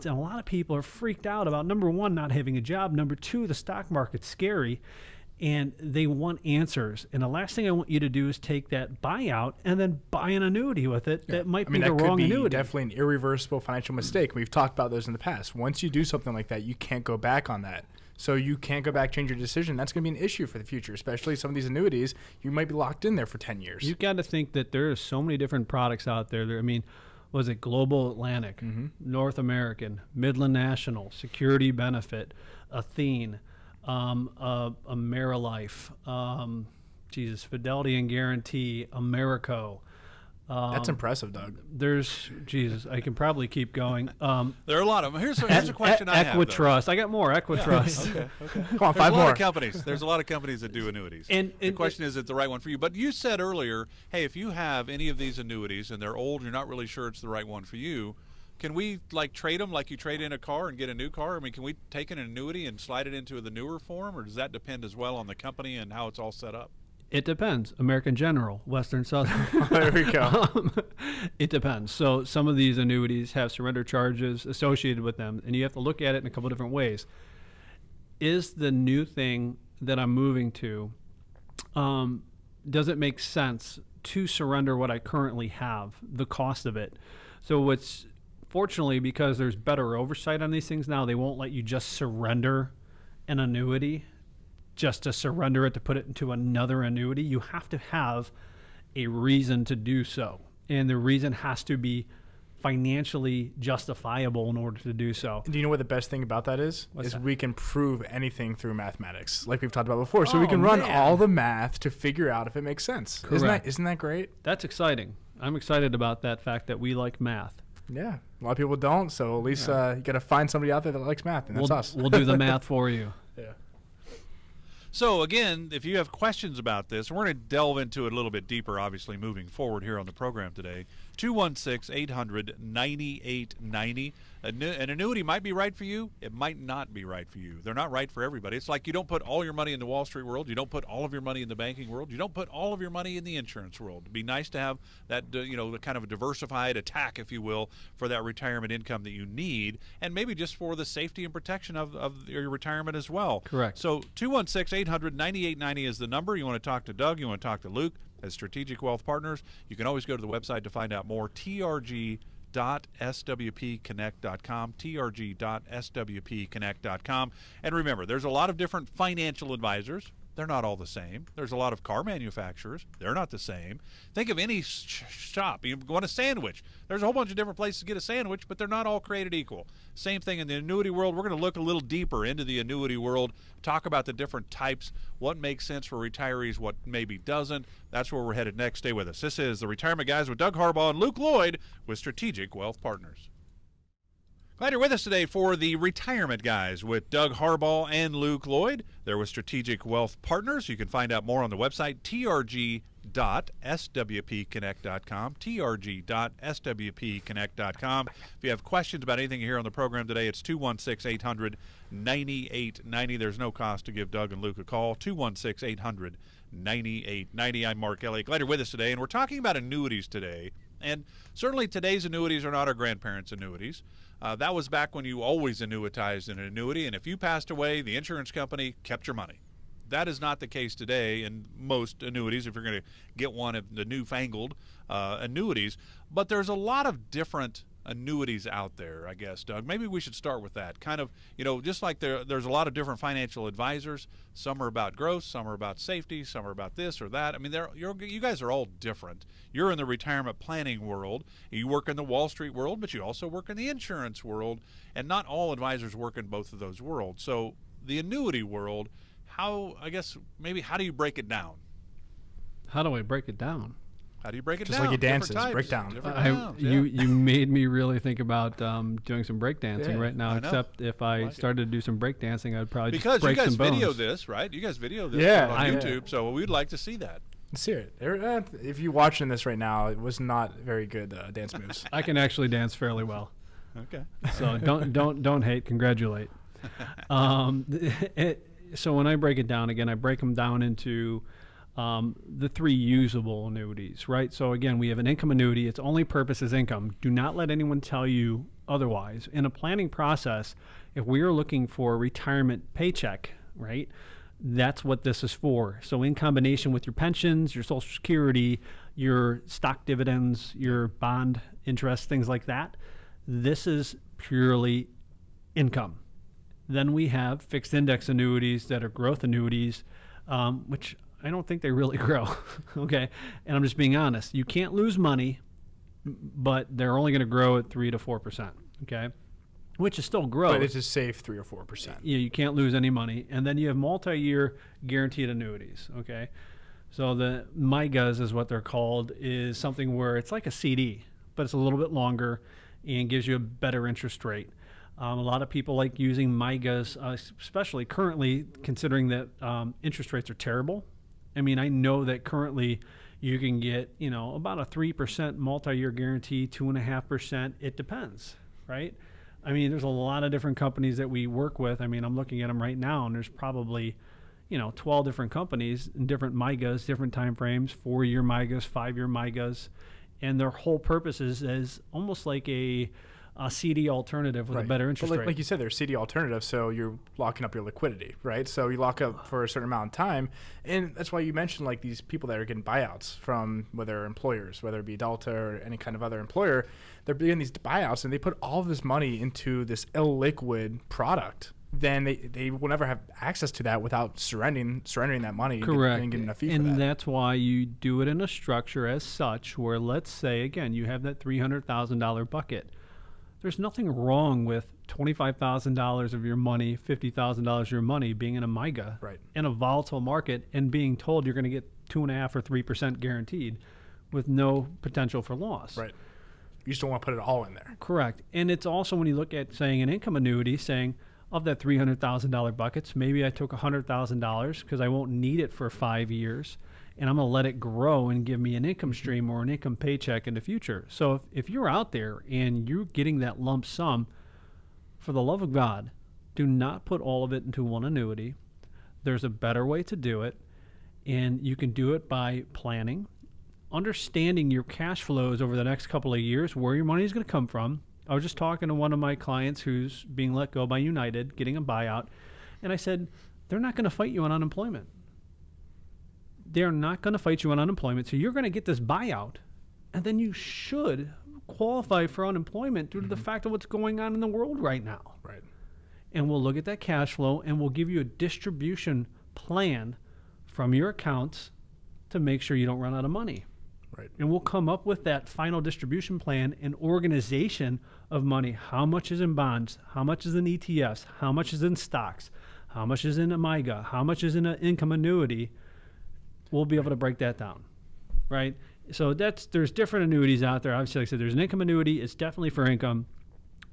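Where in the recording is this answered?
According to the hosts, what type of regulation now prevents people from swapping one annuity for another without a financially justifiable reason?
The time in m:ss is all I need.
1:29.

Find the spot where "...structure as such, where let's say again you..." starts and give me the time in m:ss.
6:38.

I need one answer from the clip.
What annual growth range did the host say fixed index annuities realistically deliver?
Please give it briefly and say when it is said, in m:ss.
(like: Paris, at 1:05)
3 to 4%, at 5:27.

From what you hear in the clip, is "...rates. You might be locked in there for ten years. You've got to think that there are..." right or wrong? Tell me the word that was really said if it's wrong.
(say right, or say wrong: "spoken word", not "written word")
wrong: "annuities", not "rates".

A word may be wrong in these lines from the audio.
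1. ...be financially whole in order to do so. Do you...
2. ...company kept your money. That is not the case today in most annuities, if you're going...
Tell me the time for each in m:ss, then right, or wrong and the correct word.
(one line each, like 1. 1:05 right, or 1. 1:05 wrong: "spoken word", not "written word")
1. 1:41 wrong: "justifiable", not "whole"
2. 3:48 right.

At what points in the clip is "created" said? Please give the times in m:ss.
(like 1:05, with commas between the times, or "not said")
2:59.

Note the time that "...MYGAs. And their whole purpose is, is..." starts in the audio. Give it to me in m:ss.
6:09.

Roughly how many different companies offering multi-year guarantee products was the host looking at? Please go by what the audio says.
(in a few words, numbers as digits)
12.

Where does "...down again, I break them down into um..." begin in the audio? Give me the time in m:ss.
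4:49.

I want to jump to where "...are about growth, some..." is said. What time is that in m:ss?
4:04.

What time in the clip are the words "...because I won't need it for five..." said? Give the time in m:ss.
7:04.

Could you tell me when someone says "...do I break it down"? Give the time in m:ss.
4:22.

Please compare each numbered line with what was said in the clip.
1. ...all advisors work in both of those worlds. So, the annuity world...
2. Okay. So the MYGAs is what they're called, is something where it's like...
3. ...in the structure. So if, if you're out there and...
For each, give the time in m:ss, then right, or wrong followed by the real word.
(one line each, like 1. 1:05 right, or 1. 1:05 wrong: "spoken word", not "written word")
1. 4:15 right
2. 5:35 right
3. 7:10 wrong: "future", not "structure".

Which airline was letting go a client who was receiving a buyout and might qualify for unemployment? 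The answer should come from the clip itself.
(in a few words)
United.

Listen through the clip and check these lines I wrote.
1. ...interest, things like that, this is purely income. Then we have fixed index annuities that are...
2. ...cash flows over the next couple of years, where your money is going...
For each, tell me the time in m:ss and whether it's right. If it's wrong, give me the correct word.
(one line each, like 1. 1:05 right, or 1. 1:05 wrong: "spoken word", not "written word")
1. 5:11 right
2. 7:24 right.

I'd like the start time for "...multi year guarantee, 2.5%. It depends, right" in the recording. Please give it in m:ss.
5:55.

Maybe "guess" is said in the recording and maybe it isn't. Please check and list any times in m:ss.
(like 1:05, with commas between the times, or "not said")
3:59, 4:19.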